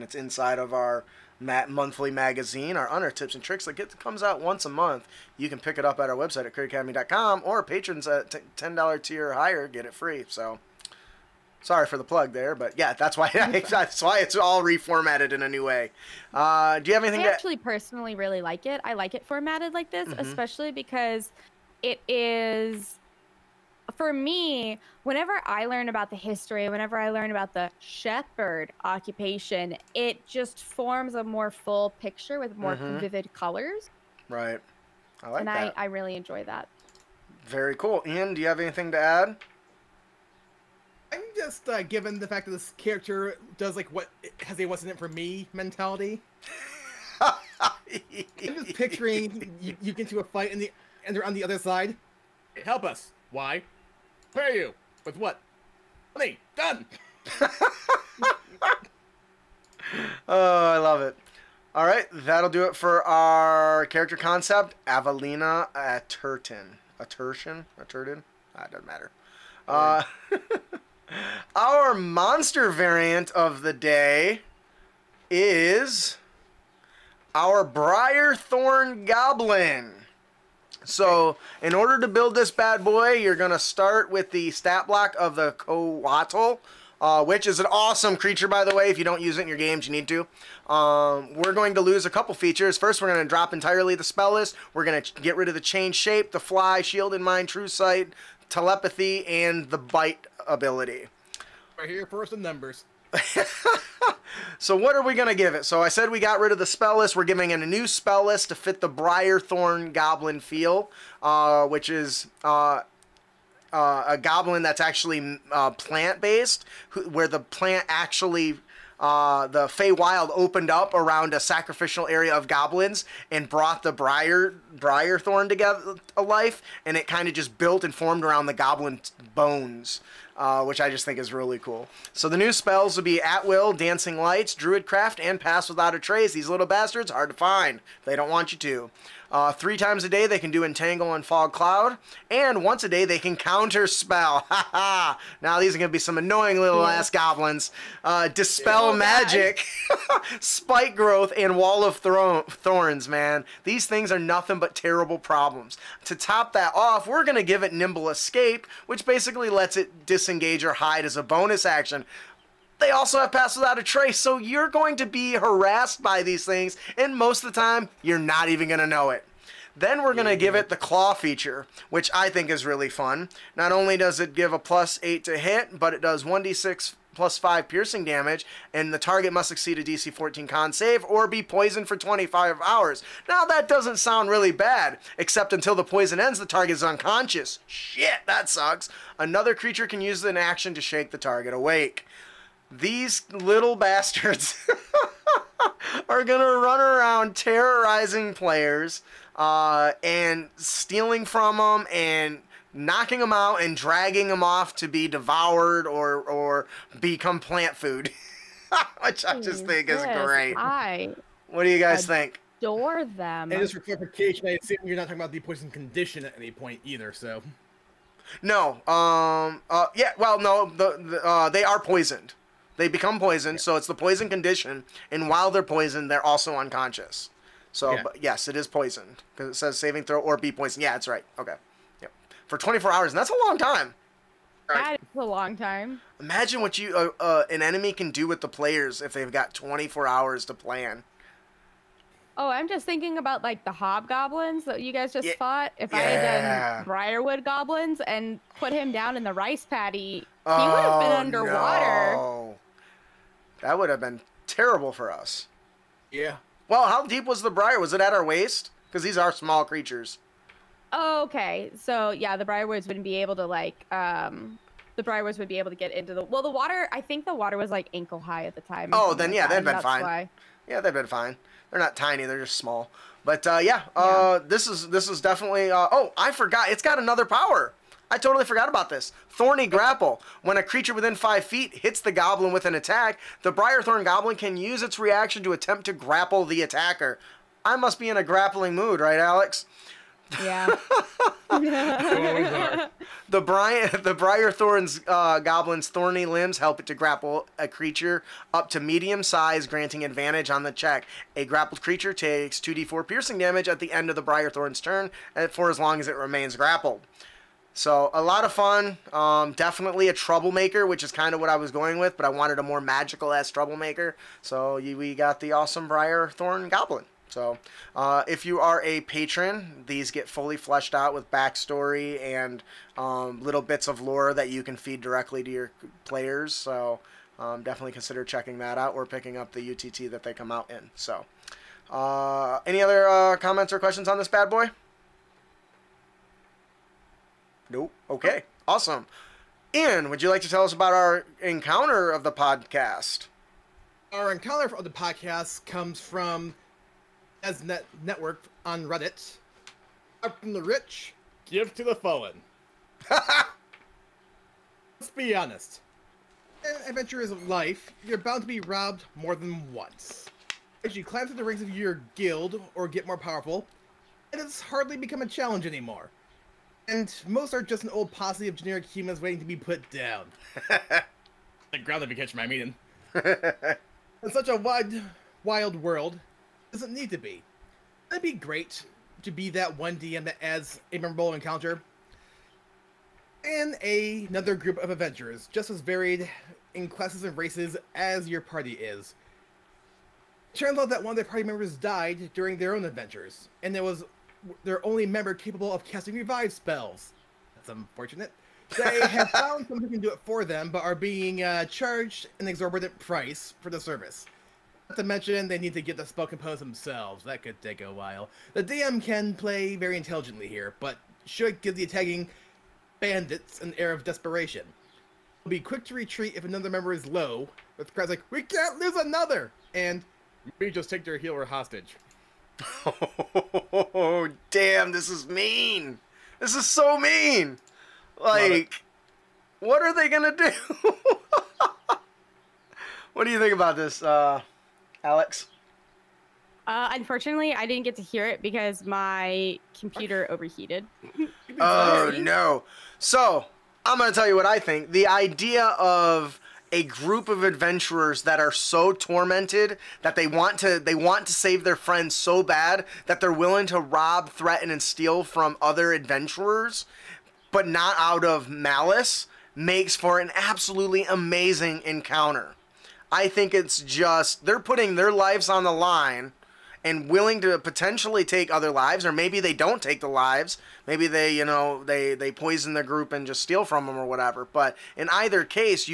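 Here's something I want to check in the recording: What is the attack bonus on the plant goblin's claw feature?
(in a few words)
+8.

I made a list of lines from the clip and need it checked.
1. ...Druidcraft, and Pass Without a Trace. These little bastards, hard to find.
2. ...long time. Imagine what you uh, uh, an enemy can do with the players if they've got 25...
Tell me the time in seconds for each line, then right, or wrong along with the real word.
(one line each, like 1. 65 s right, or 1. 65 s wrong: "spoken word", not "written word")
1. 134 s right
2. 235 s wrong: "24", not "25".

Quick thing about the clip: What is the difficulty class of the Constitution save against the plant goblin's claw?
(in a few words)
DC 14.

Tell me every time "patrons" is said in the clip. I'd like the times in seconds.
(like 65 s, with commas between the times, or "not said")
7 s, 319 s.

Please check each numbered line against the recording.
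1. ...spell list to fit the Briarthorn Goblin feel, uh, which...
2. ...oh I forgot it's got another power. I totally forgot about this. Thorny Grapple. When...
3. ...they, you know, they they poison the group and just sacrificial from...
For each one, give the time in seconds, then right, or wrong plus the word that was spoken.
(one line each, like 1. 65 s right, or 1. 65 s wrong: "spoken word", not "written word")
1. 107 s right
2. 275 s right
3. 471 s wrong: "steal", not "sacrificial".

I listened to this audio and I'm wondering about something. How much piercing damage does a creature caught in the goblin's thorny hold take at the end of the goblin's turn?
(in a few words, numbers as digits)
2d4.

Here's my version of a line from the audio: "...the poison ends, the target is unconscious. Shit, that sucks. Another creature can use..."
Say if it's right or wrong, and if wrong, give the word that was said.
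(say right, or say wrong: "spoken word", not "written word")
right.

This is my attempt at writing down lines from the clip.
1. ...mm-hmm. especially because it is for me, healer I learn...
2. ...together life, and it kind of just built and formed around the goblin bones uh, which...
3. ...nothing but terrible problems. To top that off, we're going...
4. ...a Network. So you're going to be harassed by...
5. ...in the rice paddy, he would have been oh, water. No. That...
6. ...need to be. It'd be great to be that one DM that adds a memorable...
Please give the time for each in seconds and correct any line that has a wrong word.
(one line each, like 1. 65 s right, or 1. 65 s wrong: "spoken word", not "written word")
1. 20 s wrong: "whenever", not "healer"
2. 125 s right
3. 154 s right
4. 163 s wrong: "Trace", not "Network"
5. 249 s wrong: "underwater", not "water"
6. 376 s right.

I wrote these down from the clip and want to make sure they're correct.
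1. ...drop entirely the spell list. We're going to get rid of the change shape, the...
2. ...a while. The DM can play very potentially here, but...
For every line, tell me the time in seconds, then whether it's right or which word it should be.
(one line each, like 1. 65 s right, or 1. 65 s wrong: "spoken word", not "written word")
1. 93 s right
2. 407 s wrong: "intelligently", not "potentially".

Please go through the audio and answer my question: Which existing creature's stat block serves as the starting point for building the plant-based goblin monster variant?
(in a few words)
Coatl.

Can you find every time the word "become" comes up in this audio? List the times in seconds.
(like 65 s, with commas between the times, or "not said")
206 s, 222 s, 364 s.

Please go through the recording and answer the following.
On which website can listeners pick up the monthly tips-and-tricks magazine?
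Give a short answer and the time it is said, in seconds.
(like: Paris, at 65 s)
critacademy.com, at 6 s.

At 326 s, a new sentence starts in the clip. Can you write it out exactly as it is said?
So um, definitely consider checking that out or picking up the UTT that they come out in.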